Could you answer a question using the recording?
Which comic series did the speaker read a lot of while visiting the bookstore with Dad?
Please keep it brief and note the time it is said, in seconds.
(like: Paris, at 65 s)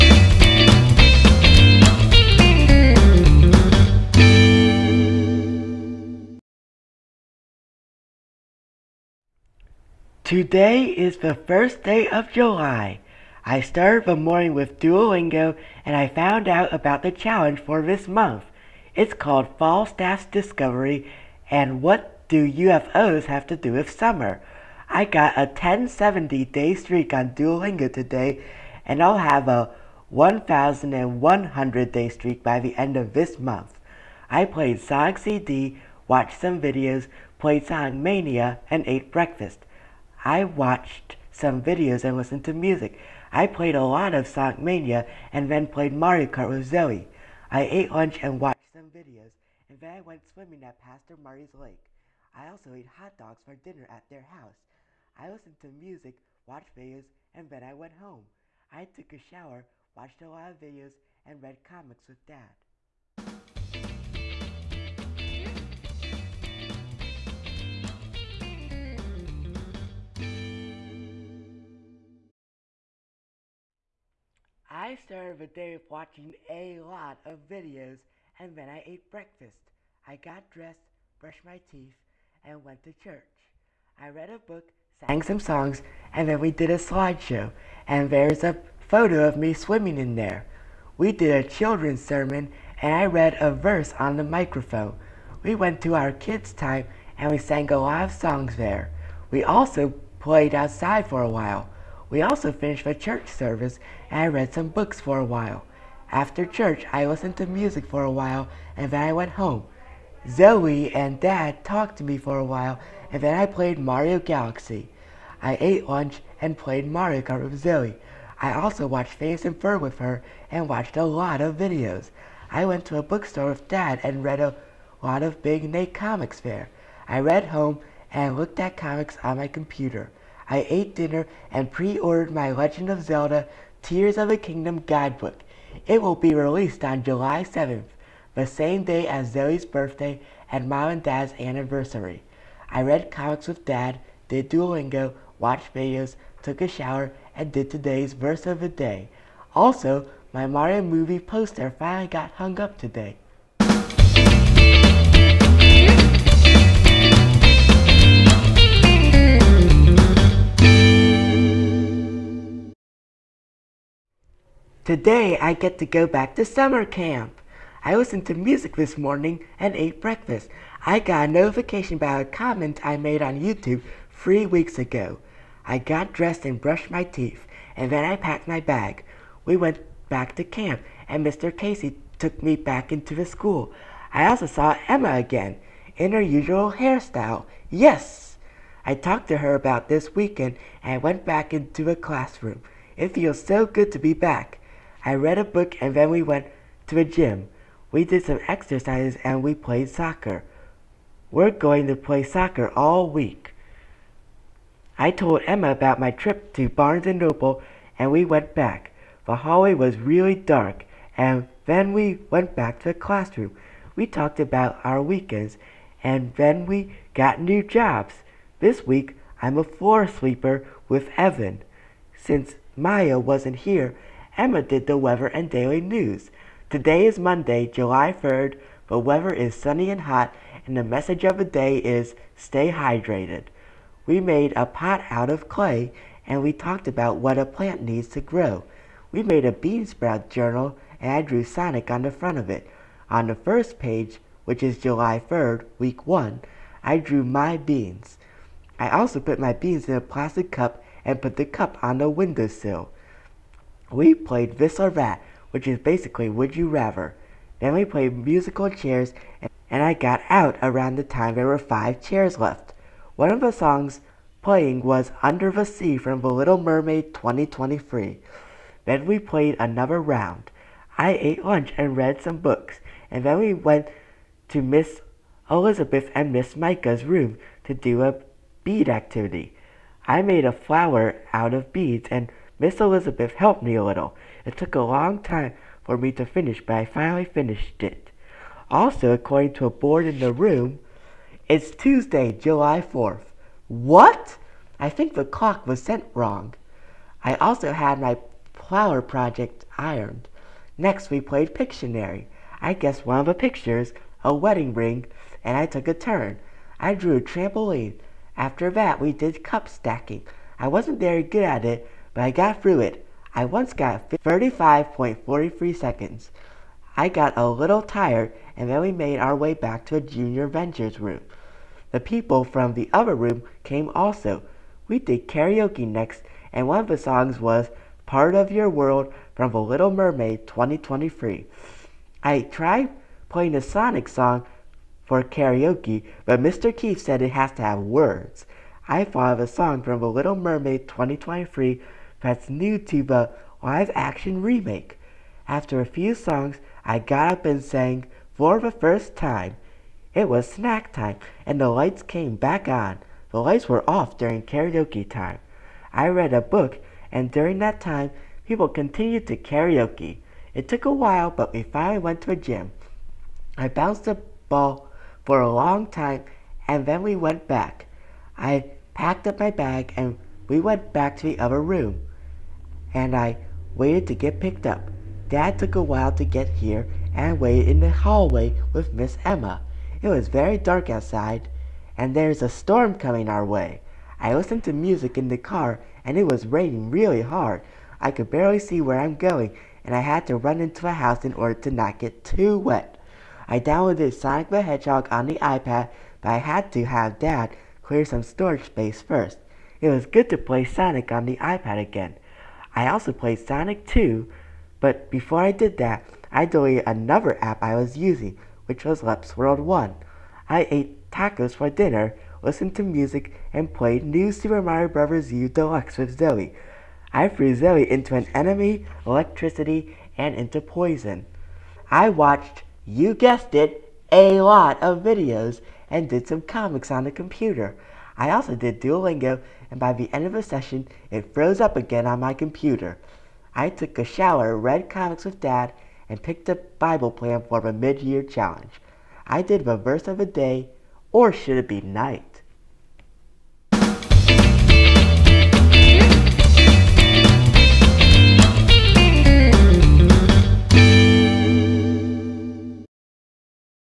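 Big Nate, at 125 s.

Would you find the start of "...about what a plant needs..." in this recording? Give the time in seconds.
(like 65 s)
236 s.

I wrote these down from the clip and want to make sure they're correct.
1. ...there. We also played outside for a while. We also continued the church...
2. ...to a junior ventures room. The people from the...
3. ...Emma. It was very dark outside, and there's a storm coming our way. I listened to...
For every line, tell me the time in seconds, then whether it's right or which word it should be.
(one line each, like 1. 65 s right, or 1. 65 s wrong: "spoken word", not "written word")
1. 98 s wrong: "finished", not "continued"
2. 319 s right
3. 379 s right.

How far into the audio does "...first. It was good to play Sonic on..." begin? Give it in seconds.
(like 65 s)
399 s.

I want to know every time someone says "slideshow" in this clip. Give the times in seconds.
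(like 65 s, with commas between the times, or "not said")
86 s.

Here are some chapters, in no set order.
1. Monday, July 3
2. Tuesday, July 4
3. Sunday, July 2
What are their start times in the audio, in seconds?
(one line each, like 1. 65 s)
1. 153 s
2. 443 s
3. 63 s.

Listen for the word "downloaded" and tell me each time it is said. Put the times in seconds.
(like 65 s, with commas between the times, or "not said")
393 s.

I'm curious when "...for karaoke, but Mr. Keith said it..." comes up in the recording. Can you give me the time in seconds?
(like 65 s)
335 s.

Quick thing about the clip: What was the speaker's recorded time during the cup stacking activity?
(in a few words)
35.43 seconds.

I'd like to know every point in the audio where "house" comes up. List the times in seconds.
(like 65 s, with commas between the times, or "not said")
54 s, 390 s.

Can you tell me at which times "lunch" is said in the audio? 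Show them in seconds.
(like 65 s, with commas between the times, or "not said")
47 s, 115 s, 271 s.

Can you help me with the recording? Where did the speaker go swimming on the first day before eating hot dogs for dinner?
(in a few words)
Pastor Marty's lake.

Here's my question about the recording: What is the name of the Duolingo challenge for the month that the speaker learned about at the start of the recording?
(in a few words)
Falstaff's Discovery.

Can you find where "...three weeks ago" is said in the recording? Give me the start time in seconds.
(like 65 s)
174 s.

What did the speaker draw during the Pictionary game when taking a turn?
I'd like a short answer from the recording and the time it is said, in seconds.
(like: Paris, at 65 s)
A trampoline, at 307 s.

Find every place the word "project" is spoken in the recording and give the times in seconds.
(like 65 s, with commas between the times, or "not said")
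299 s.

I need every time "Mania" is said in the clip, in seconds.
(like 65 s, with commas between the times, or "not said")
37 s, 44 s.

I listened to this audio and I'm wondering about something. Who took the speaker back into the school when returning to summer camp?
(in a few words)
Mr. Casey.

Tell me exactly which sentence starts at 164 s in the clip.
Today I get to go back to summer camp.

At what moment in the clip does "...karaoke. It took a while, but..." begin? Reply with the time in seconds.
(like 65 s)
359 s.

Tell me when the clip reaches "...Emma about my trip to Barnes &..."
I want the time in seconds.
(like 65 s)
205 s.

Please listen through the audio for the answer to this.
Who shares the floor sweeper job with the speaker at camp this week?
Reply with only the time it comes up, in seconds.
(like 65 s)
221 s.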